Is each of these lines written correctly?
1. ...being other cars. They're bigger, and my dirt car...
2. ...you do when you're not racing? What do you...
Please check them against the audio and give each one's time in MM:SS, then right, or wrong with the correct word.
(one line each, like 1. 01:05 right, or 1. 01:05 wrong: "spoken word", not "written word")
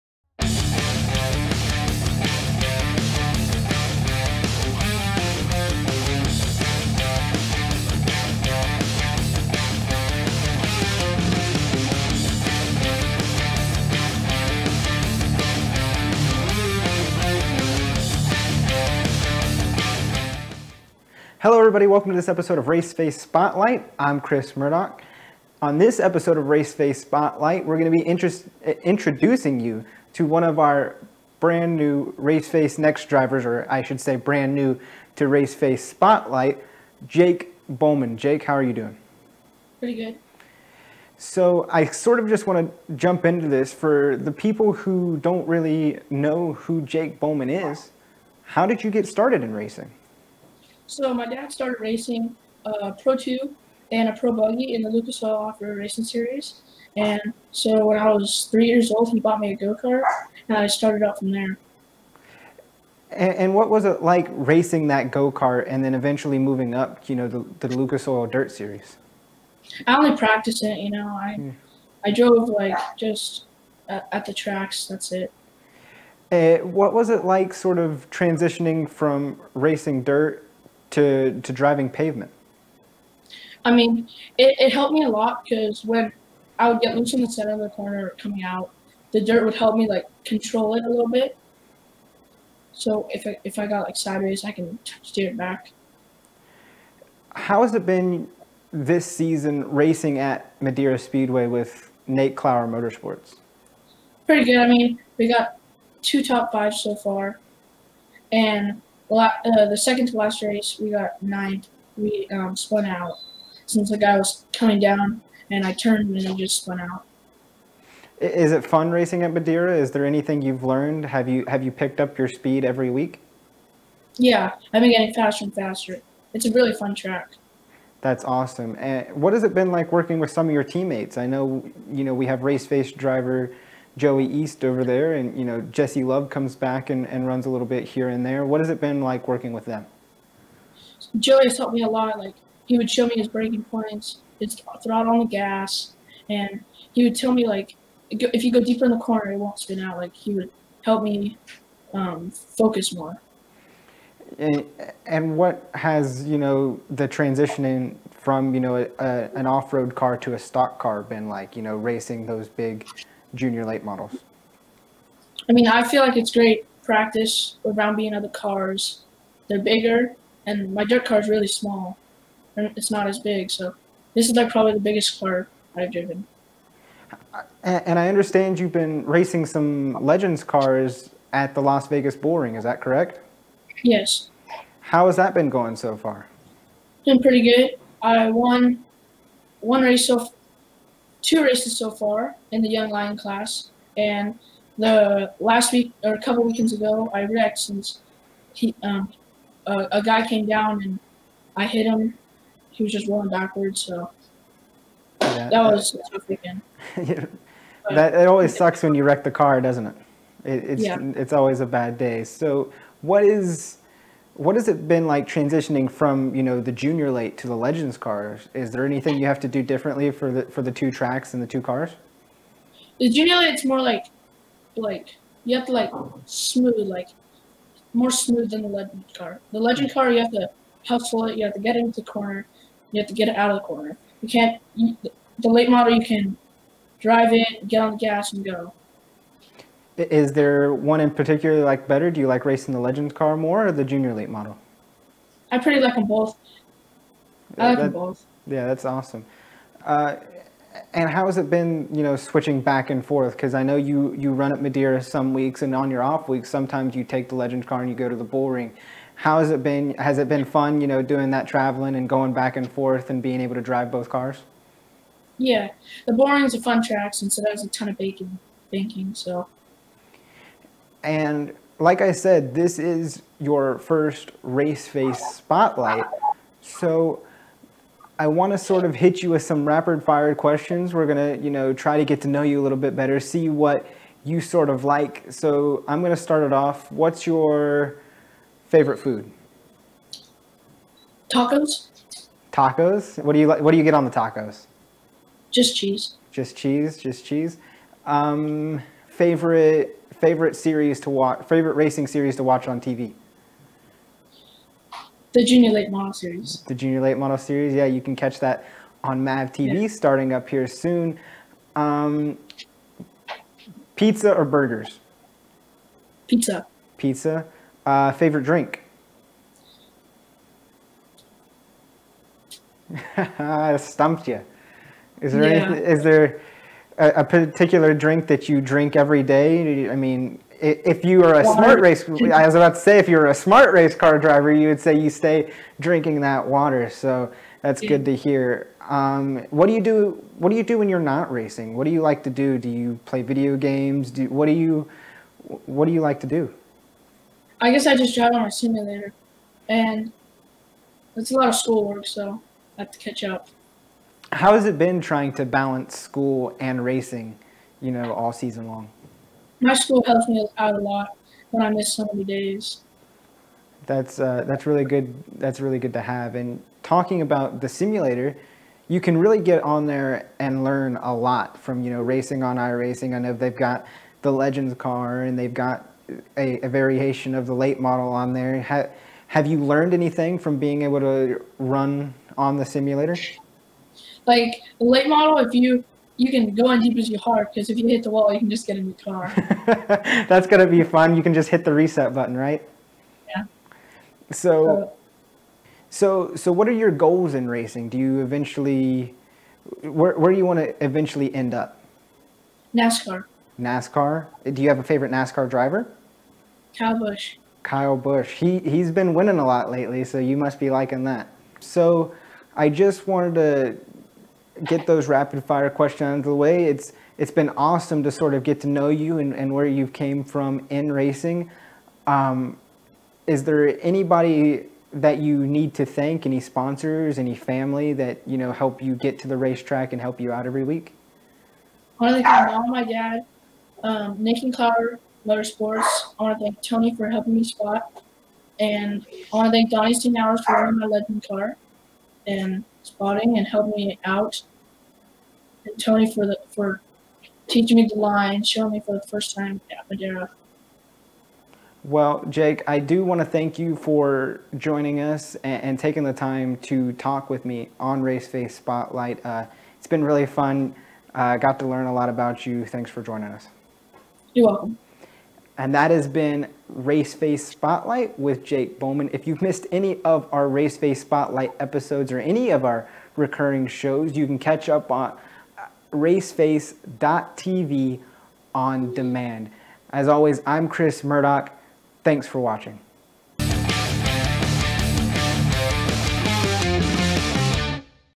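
1. 02:47 right
2. 05:40 right.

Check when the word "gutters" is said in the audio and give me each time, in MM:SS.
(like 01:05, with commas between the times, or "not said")
not said.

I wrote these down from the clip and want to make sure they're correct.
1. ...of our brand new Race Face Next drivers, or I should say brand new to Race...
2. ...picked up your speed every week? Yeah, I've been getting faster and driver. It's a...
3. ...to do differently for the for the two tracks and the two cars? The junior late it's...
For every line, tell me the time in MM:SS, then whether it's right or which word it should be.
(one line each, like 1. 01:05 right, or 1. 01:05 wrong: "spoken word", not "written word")
1. 00:30 right
2. 02:01 wrong: "faster", not "driver"
3. 03:39 right.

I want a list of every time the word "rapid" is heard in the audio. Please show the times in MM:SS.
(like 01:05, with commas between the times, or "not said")
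04:39, 06:55.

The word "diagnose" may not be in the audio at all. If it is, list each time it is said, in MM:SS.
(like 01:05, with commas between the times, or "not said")
not said.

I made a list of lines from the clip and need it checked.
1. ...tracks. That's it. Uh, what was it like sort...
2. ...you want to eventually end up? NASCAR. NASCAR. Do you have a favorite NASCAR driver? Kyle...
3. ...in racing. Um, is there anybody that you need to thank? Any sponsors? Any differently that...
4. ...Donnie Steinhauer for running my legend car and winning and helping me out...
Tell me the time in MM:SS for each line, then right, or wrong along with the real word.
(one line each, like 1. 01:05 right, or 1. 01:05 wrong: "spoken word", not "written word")
1. 01:14 right
2. 06:40 right
3. 07:00 wrong: "family", not "differently"
4. 07:19 wrong: "spotting", not "winning".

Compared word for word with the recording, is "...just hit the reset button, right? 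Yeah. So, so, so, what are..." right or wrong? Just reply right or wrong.
right.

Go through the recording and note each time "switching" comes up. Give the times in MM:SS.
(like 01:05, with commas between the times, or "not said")
04:12.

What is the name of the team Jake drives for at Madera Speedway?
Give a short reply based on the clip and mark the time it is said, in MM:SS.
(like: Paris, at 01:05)
Nate Clower Motorsports, at 01:42.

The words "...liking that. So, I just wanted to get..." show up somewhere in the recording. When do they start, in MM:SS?
06:50.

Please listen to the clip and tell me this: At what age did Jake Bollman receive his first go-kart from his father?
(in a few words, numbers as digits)
3.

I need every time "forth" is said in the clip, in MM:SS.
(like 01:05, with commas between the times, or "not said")
04:13, 04:22.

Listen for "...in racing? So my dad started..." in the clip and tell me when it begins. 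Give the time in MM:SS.
00:49.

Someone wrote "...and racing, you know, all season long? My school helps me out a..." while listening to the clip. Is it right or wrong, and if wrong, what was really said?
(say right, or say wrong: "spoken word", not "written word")
right.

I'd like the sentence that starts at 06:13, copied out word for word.
I know they've got the Legends car and they've got a, a variation of the late model on there.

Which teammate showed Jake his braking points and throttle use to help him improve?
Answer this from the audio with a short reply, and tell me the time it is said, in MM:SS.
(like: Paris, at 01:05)
Joey East, at 02:13.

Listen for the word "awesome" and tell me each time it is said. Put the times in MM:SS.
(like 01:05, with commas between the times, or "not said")
02:08, 04:08, 06:57.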